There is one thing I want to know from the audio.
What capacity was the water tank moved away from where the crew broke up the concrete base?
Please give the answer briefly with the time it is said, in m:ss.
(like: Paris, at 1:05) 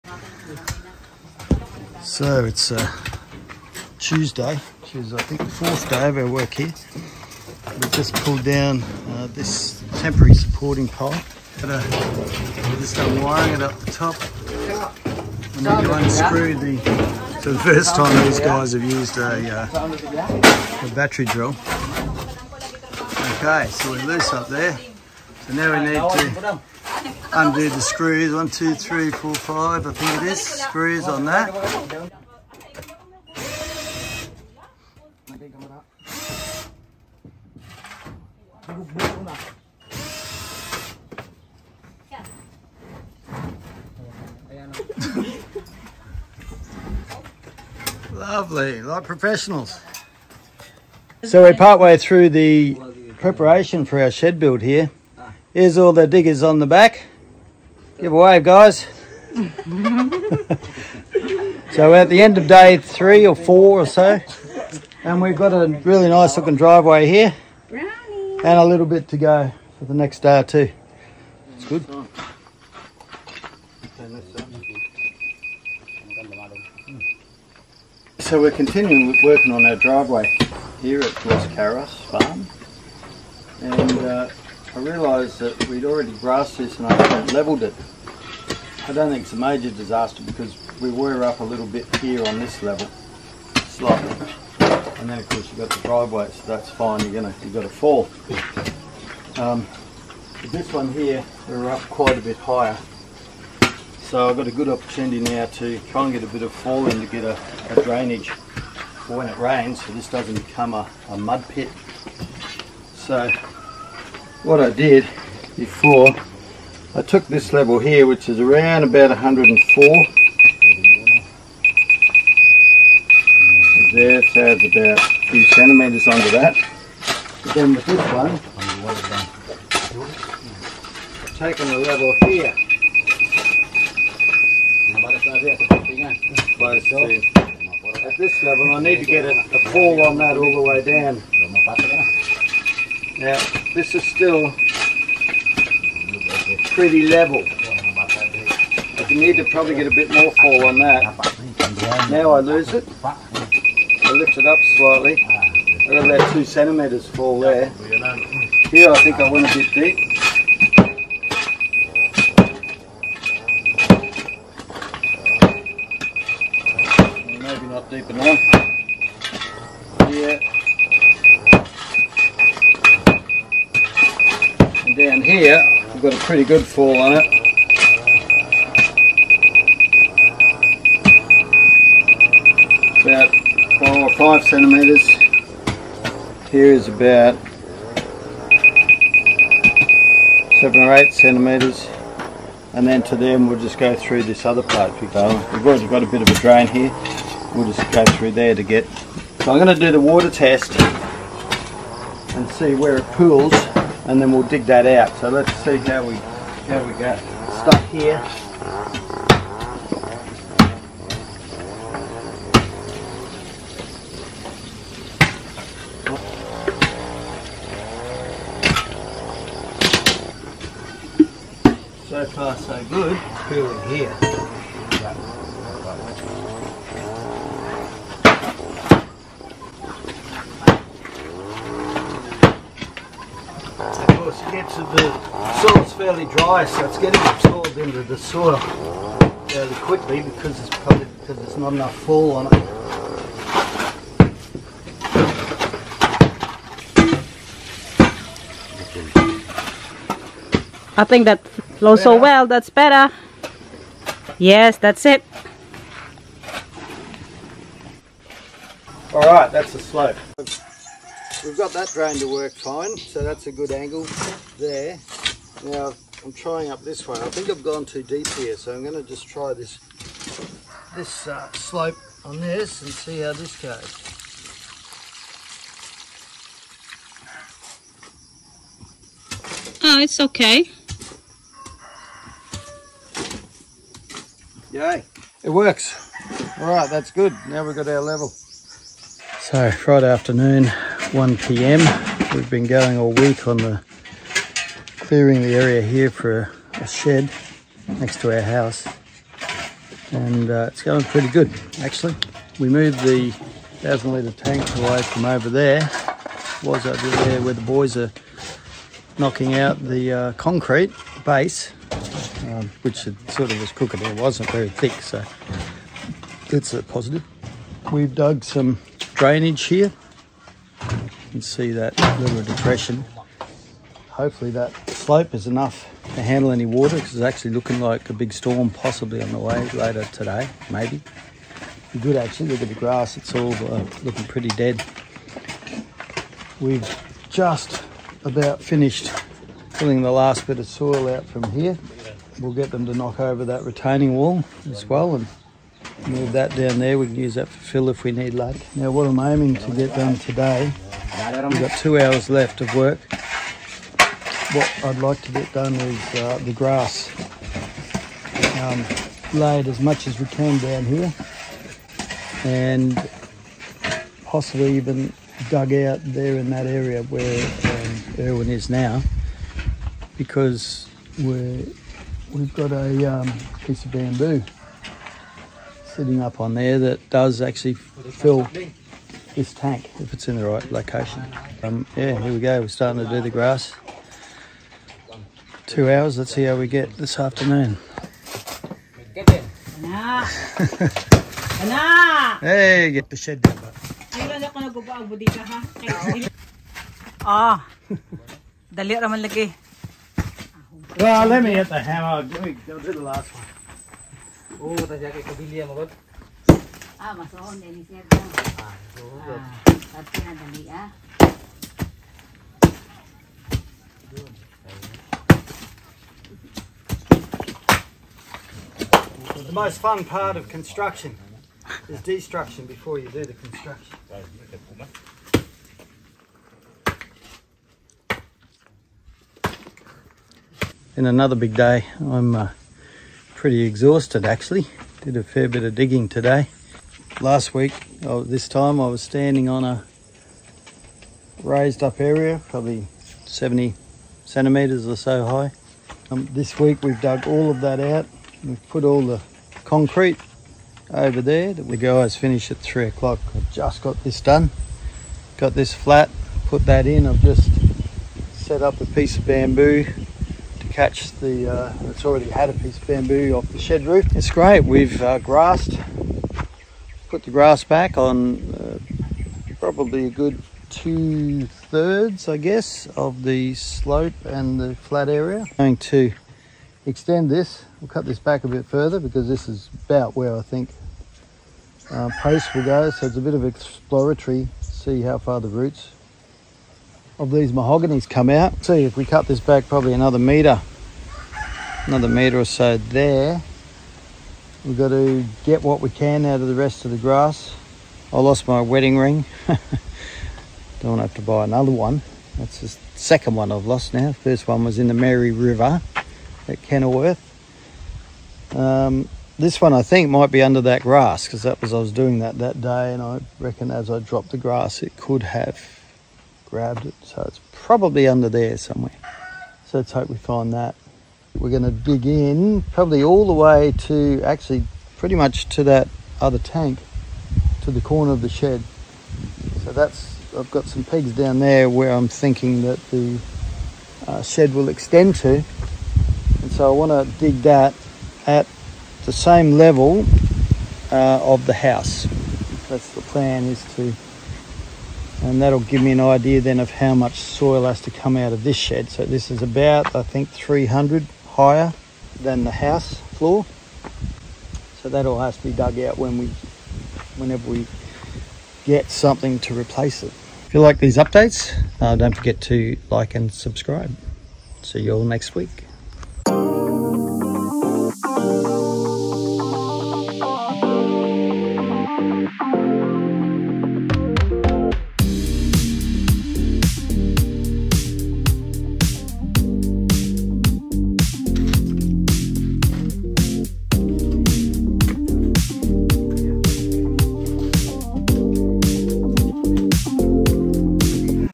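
1000 litres, at 5:03.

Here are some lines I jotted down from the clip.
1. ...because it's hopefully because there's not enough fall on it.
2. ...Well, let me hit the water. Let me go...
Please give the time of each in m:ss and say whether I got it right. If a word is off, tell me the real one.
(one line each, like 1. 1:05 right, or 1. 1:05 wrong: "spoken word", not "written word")
1. 4:00 wrong: "probably", not "hopefully"
2. 6:40 wrong: "hammer", not "water".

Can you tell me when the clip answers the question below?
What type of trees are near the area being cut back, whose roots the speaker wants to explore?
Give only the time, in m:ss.
8:07.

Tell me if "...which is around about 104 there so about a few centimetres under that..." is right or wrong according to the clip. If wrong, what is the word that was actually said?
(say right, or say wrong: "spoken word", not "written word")
right.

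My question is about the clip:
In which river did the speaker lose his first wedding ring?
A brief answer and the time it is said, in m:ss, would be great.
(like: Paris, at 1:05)
Mary River, at 8:24.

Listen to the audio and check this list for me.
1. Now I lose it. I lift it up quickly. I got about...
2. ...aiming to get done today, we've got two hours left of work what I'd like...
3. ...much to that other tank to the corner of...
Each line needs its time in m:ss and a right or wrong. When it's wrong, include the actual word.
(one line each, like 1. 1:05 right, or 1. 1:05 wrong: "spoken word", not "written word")
1. 2:32 wrong: "slightly", not "quickly"
2. 5:49 right
3. 8:45 right.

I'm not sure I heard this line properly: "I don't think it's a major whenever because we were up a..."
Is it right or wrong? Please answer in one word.
wrong.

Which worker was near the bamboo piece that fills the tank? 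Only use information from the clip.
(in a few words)
Irwin.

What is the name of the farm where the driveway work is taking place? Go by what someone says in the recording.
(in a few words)
Ross Carras Farm.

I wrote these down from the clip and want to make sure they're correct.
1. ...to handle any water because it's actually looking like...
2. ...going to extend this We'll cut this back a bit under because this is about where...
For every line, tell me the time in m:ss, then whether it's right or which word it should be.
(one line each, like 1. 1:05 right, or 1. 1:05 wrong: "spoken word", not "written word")
1. 5:26 right
2. 7:55 wrong: "further", not "under".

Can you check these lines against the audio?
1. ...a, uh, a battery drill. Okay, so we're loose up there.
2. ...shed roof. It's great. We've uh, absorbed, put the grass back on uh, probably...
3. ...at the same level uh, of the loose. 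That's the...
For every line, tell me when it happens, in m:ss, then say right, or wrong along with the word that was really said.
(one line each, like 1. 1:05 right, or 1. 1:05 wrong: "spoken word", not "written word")
1. 0:19 right
2. 7:43 wrong: "grassed", not "absorbed"
3. 8:58 wrong: "house", not "loose".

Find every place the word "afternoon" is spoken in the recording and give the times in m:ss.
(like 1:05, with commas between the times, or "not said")
4:50, 6:27.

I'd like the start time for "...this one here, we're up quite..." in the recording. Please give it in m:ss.
1:40.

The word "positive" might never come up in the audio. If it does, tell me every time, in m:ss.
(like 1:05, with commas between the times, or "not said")
5:16.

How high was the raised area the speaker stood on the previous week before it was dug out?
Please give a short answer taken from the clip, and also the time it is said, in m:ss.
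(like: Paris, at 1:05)
70 centimetres, at 7:23.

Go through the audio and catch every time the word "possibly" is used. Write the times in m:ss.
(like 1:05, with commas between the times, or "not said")
5:28, 6:04.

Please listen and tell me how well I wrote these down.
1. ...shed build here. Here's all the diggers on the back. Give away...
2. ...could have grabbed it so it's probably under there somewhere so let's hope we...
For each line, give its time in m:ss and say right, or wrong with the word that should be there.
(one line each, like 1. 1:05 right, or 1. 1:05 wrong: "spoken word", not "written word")
1. 0:54 right
2. 8:34 right.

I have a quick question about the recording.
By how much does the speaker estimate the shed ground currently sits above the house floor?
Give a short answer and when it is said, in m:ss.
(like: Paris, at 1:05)
300, at 9:10.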